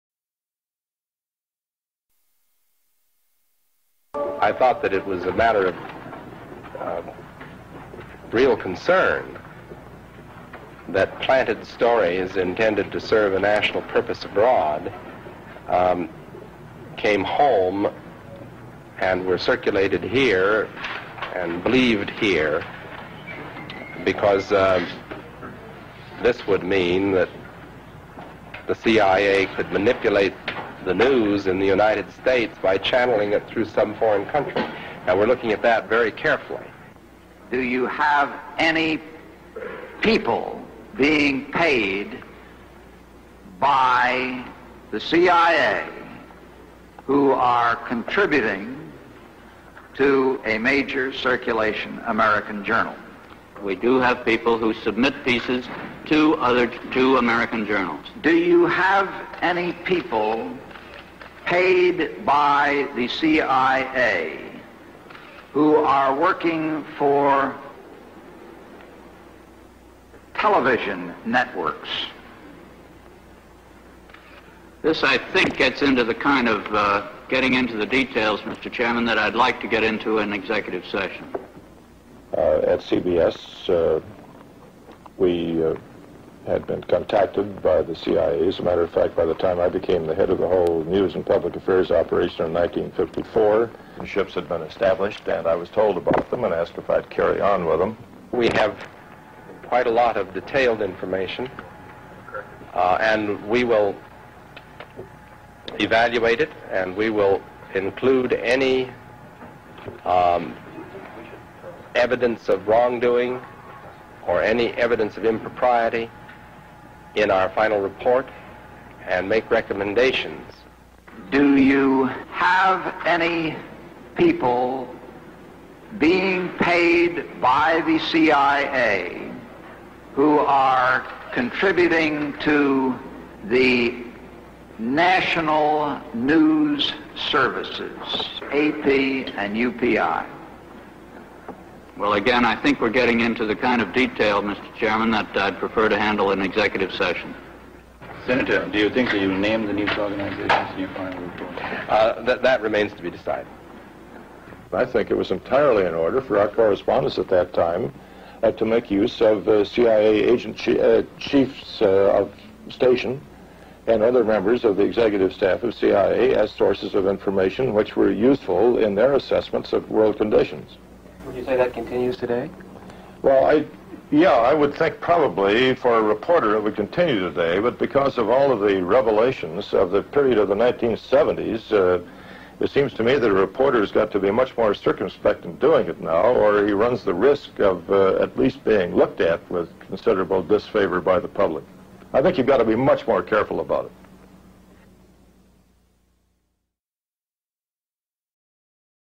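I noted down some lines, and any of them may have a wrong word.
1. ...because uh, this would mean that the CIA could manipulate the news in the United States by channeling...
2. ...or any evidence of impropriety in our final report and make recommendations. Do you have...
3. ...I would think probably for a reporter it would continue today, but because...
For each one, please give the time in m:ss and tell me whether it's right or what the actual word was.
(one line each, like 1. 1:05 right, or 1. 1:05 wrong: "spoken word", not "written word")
1. 0:24 right
2. 1:54 right
3. 2:54 right.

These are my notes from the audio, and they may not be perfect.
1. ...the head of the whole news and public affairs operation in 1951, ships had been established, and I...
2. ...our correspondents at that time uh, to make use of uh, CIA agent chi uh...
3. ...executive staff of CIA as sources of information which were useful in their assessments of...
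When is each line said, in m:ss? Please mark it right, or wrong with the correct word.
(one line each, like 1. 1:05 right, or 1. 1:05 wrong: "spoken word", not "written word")
1. 1:30 wrong: "1954", not "1951"
2. 2:36 right
3. 2:44 right.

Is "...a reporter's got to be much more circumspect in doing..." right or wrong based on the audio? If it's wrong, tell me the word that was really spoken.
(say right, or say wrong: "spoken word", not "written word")
right.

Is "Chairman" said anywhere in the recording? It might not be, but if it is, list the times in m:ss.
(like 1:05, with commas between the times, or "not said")
1:18, 2:24.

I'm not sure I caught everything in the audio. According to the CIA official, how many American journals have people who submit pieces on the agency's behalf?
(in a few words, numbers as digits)
2.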